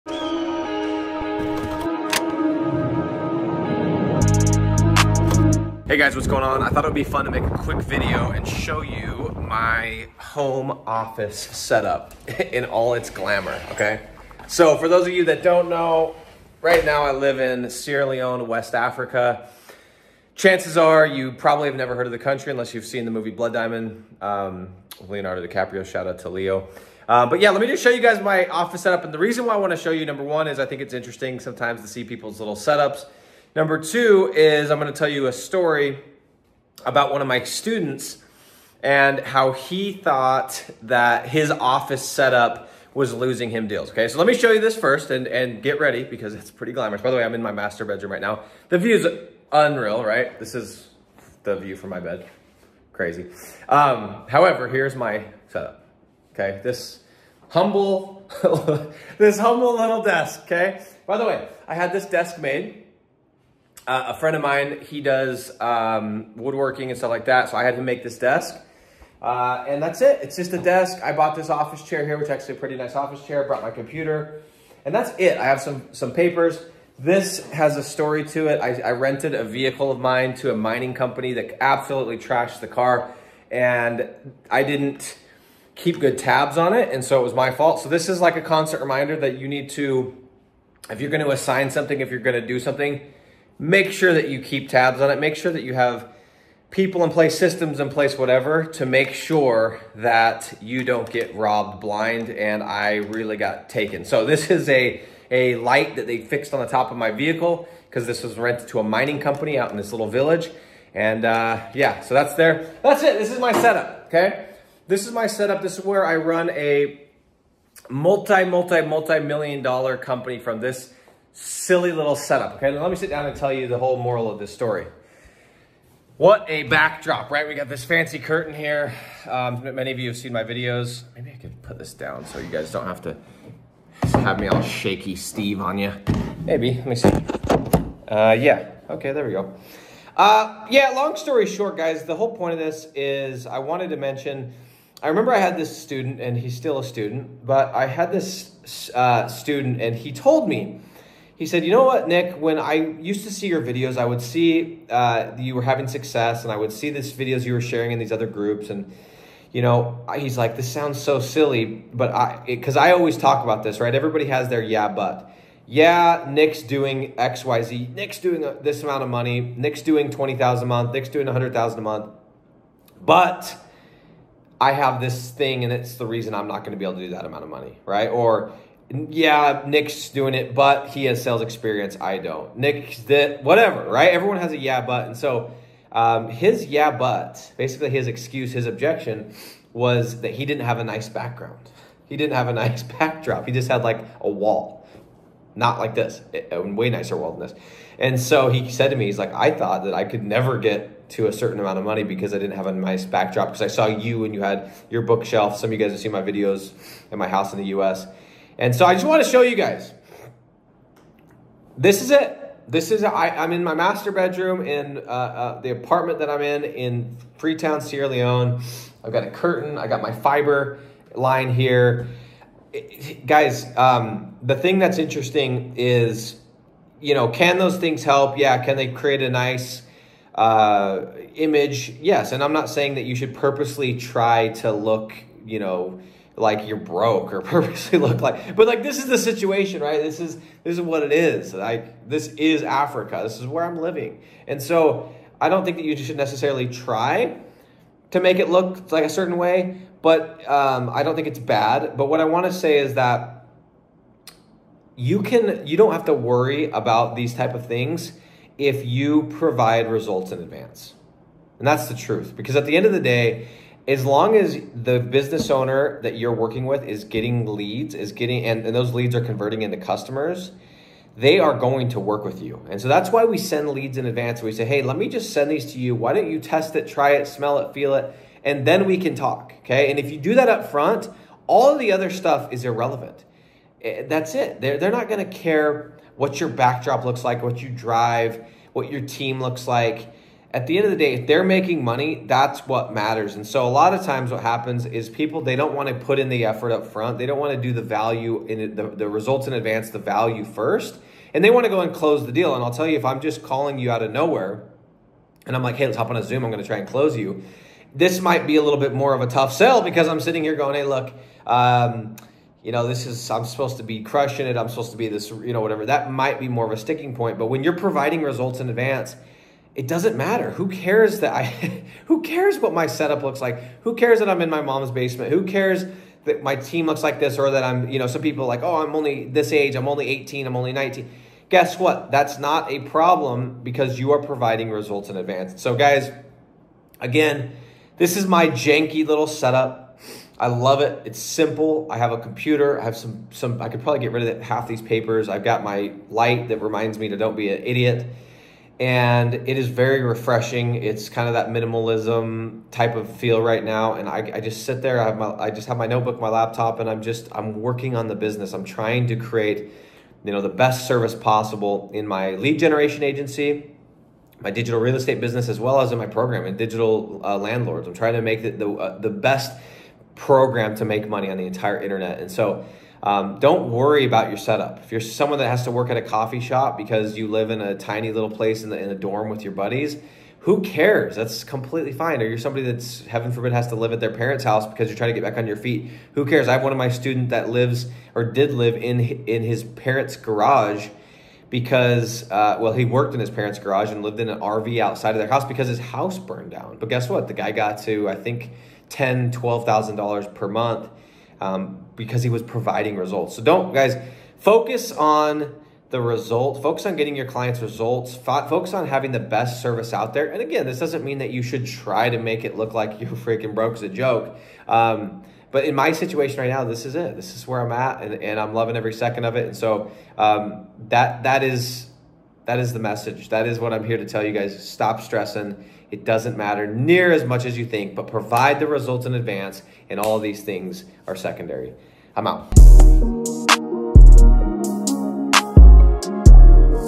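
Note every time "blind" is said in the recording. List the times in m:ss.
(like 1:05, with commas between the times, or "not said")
1:41.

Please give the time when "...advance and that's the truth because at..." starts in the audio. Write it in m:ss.
4:20.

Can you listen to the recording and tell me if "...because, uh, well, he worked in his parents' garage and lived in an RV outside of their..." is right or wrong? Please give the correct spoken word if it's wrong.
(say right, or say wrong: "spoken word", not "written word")
right.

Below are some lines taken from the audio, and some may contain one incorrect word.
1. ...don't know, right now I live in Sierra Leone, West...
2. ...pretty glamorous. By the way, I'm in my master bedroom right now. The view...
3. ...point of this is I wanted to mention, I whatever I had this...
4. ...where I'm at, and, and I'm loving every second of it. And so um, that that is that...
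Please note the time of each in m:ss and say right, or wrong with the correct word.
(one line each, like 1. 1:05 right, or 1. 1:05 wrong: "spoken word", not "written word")
1. 0:15 right
2. 0:46 right
3. 2:22 wrong: "remember", not "whatever"
4. 6:57 right.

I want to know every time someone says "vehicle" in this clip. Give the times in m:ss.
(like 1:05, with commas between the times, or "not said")
1:19, 1:47.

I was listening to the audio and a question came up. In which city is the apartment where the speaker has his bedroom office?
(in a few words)
Freetown.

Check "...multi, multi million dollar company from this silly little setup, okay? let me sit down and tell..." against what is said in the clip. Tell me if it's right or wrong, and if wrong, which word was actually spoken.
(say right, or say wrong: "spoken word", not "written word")
right.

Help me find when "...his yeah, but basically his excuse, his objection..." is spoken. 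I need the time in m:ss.
3:06.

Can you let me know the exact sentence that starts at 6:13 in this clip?
Um, don't worry about your setup.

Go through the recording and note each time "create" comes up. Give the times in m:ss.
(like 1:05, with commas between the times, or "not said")
3:48, 5:59.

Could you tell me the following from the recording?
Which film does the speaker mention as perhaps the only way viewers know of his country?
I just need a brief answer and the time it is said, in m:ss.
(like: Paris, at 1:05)
Blood Diamond, at 0:23.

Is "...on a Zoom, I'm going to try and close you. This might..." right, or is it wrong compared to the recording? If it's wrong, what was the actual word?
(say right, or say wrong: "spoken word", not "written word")
right.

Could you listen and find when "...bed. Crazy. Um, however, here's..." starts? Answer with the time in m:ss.
0:51.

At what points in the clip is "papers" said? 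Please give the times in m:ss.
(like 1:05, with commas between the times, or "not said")
1:16, 5:44.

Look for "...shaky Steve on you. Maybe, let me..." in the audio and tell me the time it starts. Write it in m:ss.
2:14.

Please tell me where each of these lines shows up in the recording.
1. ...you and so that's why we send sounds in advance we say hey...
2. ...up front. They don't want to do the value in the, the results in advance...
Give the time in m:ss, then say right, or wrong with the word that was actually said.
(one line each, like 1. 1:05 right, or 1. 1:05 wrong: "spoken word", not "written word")
1. 4:32 wrong: "leads", not "sounds"
2. 4:56 right.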